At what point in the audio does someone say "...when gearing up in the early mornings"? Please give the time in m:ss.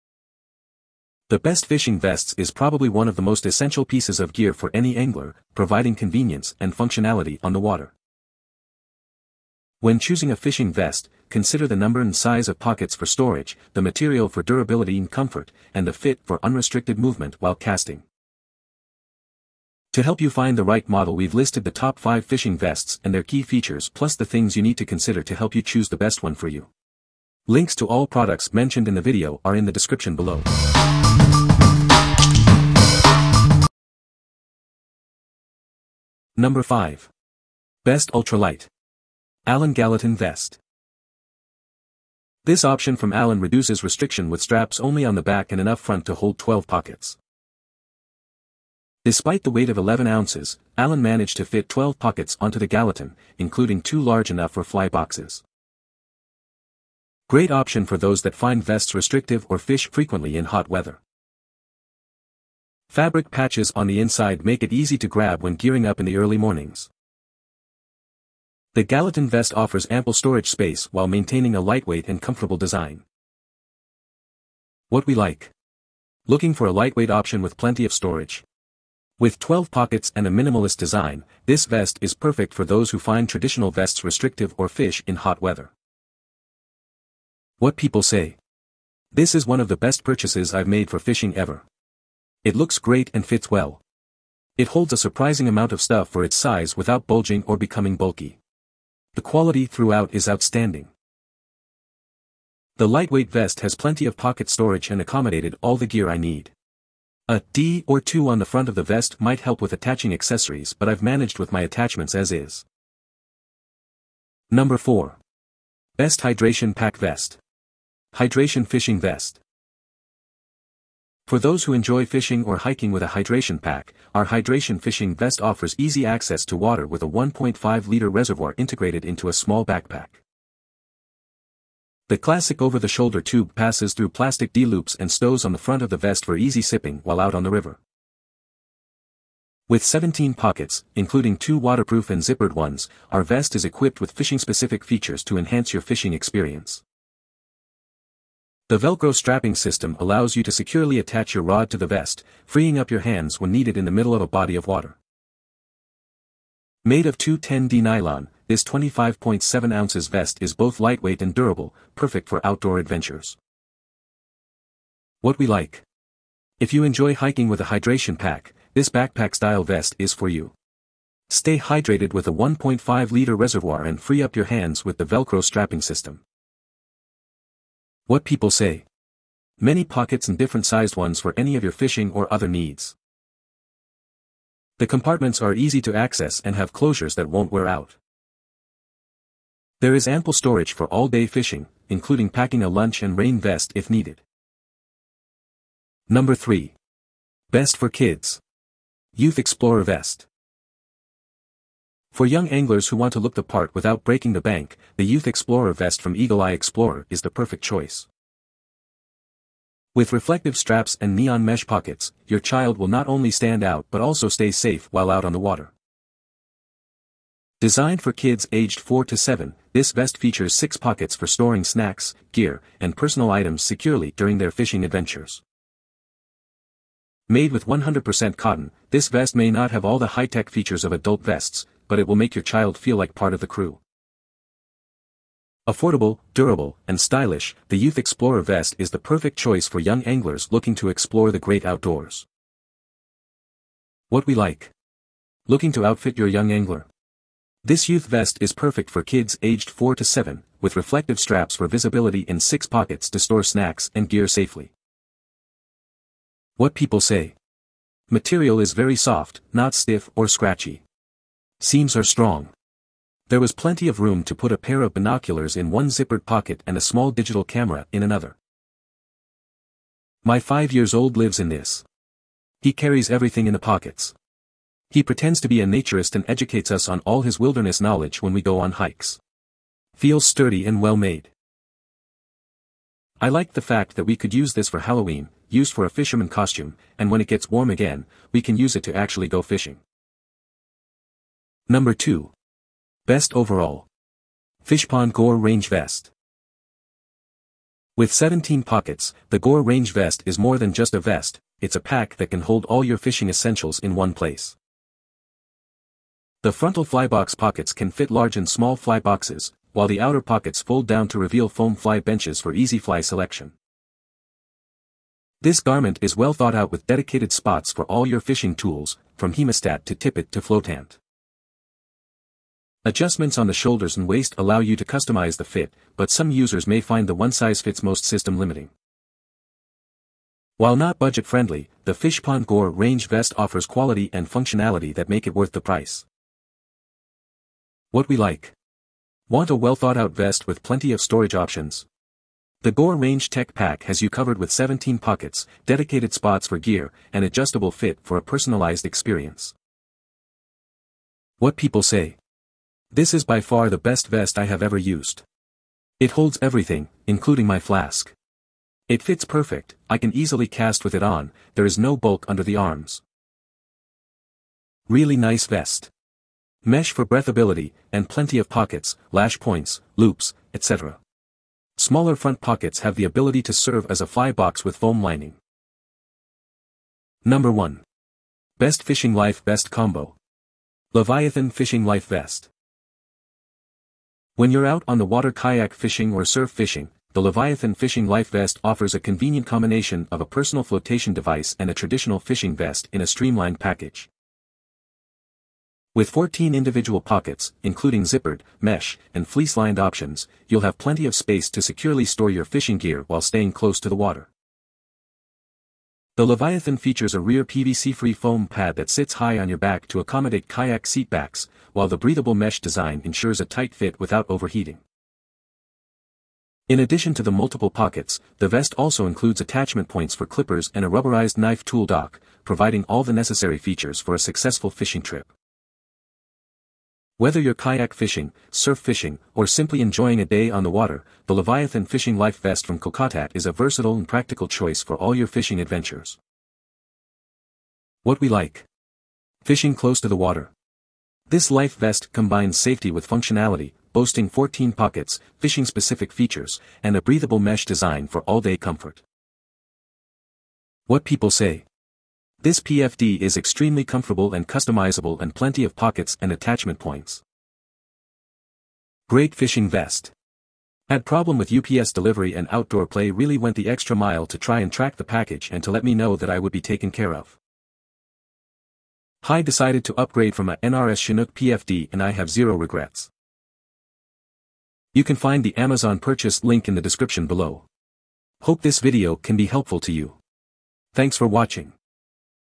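1:05.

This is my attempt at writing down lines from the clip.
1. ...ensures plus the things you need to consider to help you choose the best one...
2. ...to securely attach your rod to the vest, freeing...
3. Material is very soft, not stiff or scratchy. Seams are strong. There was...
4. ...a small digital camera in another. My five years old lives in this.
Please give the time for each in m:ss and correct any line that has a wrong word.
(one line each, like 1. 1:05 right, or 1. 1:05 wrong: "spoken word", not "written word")
1. 0:23 wrong: "features", not "ensures"
2. 2:30 right
3. 4:18 right
4. 4:26 right.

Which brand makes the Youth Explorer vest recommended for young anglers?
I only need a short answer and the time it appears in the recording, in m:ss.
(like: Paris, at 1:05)
Eagle Eye Explorer, at 3:26.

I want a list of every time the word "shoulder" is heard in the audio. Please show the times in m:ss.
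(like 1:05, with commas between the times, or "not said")
2:12, 5:23.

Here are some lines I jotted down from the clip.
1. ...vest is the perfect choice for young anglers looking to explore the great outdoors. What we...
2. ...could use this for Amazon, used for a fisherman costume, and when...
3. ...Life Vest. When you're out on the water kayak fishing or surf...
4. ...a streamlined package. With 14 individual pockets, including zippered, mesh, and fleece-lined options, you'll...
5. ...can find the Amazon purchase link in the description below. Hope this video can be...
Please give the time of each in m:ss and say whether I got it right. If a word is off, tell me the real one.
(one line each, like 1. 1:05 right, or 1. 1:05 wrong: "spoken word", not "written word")
1. 3:58 right
2. 4:44 wrong: "Halloween", not "Amazon"
3. 6:21 right
4. 6:33 right
5. 7:55 right.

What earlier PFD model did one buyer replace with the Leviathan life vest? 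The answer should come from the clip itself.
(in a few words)
NRS Chinook.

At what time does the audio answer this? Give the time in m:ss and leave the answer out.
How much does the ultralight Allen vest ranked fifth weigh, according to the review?
0:49.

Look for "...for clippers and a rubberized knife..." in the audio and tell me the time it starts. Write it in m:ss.
7:00.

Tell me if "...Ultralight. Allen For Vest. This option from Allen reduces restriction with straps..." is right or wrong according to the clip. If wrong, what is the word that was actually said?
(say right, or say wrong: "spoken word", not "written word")
wrong: "Gallatin", not "For".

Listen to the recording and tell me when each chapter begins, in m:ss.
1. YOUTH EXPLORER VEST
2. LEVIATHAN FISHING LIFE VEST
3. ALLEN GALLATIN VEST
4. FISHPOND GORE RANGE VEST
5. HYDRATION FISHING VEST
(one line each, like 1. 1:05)
1. 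3:14
2. 6:15
3. 0:35
4. 4:50
5. 1:53.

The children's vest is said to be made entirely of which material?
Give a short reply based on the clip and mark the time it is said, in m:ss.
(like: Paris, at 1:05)
cotton, at 3:47.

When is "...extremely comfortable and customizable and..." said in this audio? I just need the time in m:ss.
7:33.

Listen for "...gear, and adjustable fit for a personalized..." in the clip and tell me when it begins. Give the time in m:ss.
5:46.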